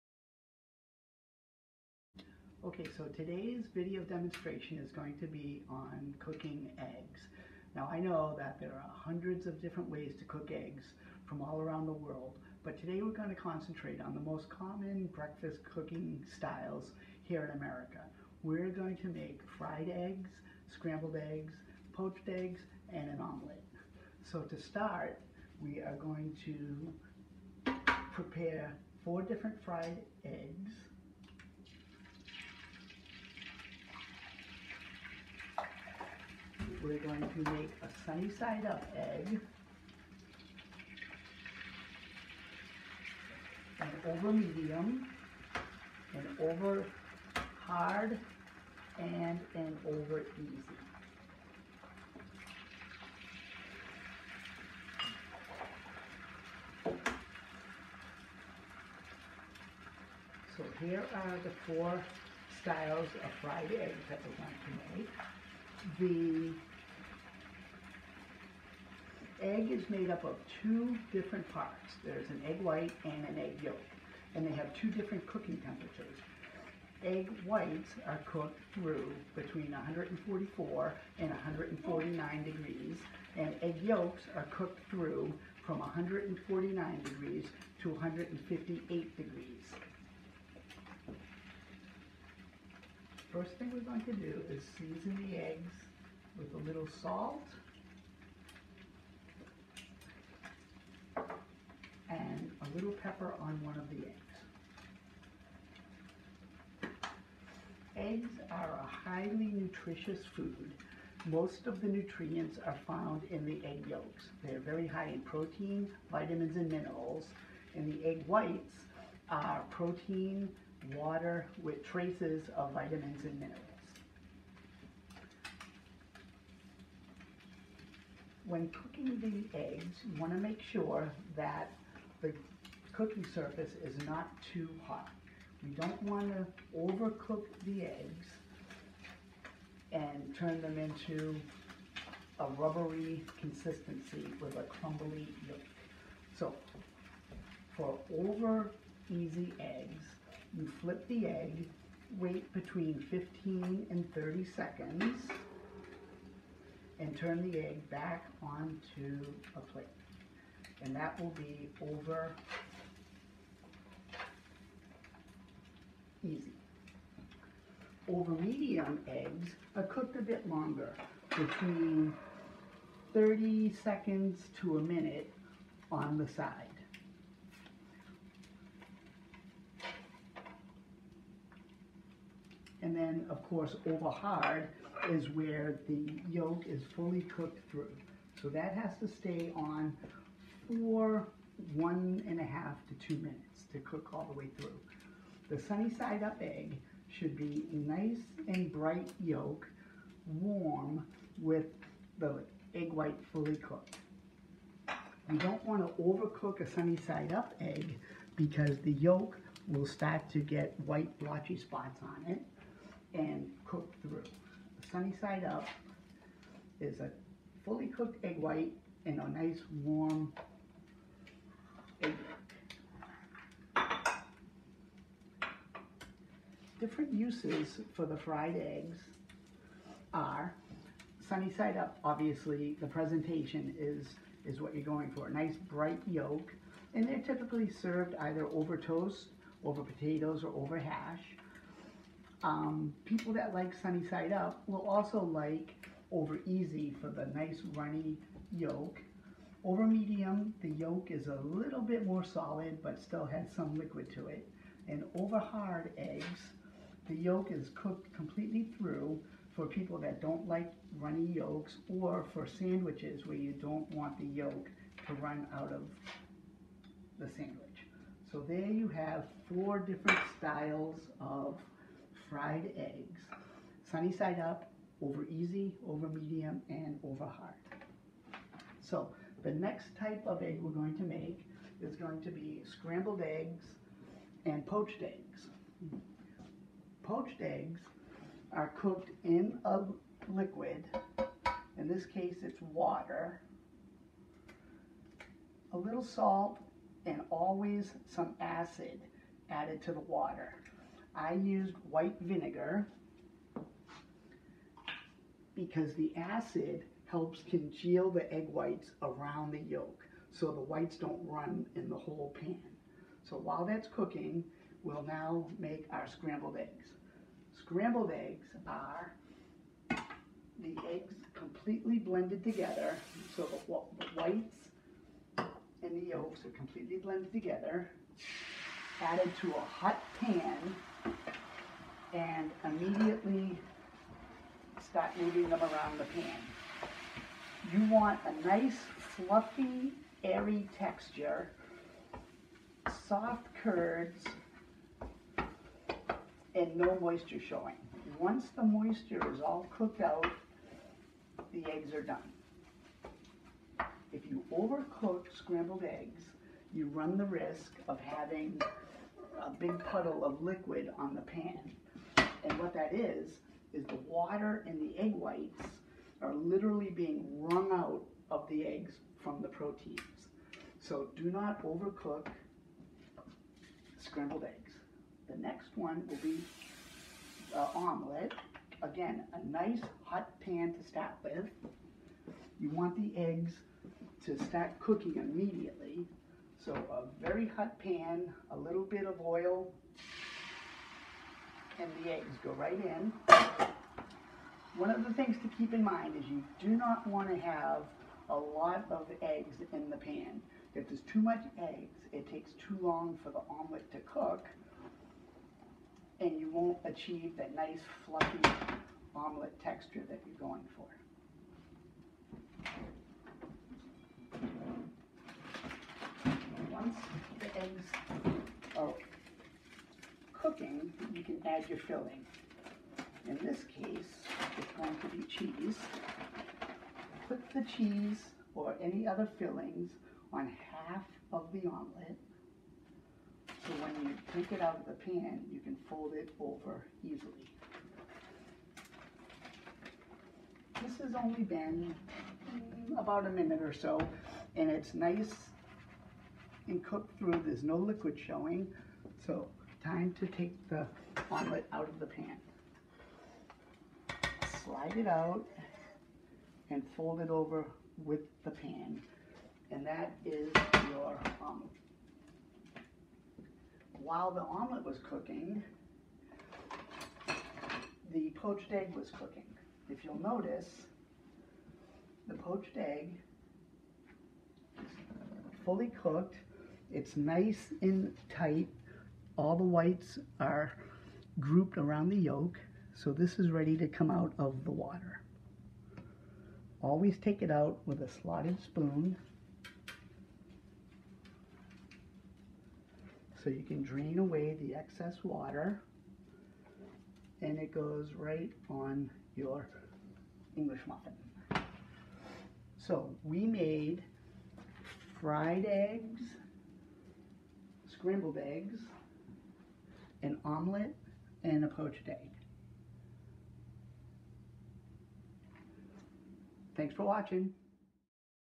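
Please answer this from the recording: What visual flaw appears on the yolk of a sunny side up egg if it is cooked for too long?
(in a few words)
white blotchy spots.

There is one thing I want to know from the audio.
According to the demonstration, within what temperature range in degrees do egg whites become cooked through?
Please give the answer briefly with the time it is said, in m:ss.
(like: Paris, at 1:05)
144 to 149, at 1:19.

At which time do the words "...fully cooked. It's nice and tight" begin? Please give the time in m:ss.
7:55.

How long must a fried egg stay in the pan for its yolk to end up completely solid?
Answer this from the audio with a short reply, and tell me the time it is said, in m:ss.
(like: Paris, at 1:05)
1.5 to 2 minutes, at 3:11.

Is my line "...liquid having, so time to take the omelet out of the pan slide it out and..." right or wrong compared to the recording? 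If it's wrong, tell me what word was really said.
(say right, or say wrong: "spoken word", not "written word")
wrong: "showing", not "having".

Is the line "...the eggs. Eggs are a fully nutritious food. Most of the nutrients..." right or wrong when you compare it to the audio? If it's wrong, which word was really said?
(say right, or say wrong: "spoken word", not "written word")
wrong: "highly", not "fully".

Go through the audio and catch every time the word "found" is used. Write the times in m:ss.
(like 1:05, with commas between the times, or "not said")
1:52.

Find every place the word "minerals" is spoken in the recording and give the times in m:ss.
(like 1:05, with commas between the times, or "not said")
1:56, 2:03.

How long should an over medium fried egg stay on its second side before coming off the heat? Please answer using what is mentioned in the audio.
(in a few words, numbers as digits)
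30 seconds to a minute.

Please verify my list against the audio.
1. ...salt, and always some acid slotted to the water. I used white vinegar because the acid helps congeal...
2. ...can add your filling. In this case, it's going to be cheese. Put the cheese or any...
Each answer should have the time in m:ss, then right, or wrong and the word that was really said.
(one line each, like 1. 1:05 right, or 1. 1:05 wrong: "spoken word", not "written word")
1. 4:56 wrong: "added", not "slotted"
2. 7:01 right.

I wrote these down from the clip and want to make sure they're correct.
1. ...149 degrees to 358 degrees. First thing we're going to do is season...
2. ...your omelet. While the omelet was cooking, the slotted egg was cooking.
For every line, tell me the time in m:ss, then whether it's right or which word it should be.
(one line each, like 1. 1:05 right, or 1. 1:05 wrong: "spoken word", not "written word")
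1. 1:25 wrong: "158", not "358"
2. 7:40 wrong: "poached", not "slotted".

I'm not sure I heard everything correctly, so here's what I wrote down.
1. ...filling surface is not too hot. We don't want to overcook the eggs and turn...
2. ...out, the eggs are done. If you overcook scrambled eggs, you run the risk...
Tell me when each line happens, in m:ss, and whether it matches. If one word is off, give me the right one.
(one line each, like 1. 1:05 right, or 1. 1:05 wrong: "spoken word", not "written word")
1. 2:12 wrong: "cooking", not "filling"
2. 5:50 right.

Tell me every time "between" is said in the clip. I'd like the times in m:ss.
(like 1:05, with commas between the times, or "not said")
1:19, 2:32, 2:51.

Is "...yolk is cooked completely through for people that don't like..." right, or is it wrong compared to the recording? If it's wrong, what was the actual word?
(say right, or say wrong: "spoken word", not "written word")
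right.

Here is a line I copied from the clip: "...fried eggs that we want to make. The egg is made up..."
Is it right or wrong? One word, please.
right.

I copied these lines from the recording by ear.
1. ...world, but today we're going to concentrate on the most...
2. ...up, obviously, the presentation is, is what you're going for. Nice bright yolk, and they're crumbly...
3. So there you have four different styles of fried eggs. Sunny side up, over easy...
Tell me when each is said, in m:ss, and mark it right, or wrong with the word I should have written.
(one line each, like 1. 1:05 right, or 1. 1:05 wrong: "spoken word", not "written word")
1. 0:11 right
2. 3:51 wrong: "typically", not "crumbly"
3. 4:28 right.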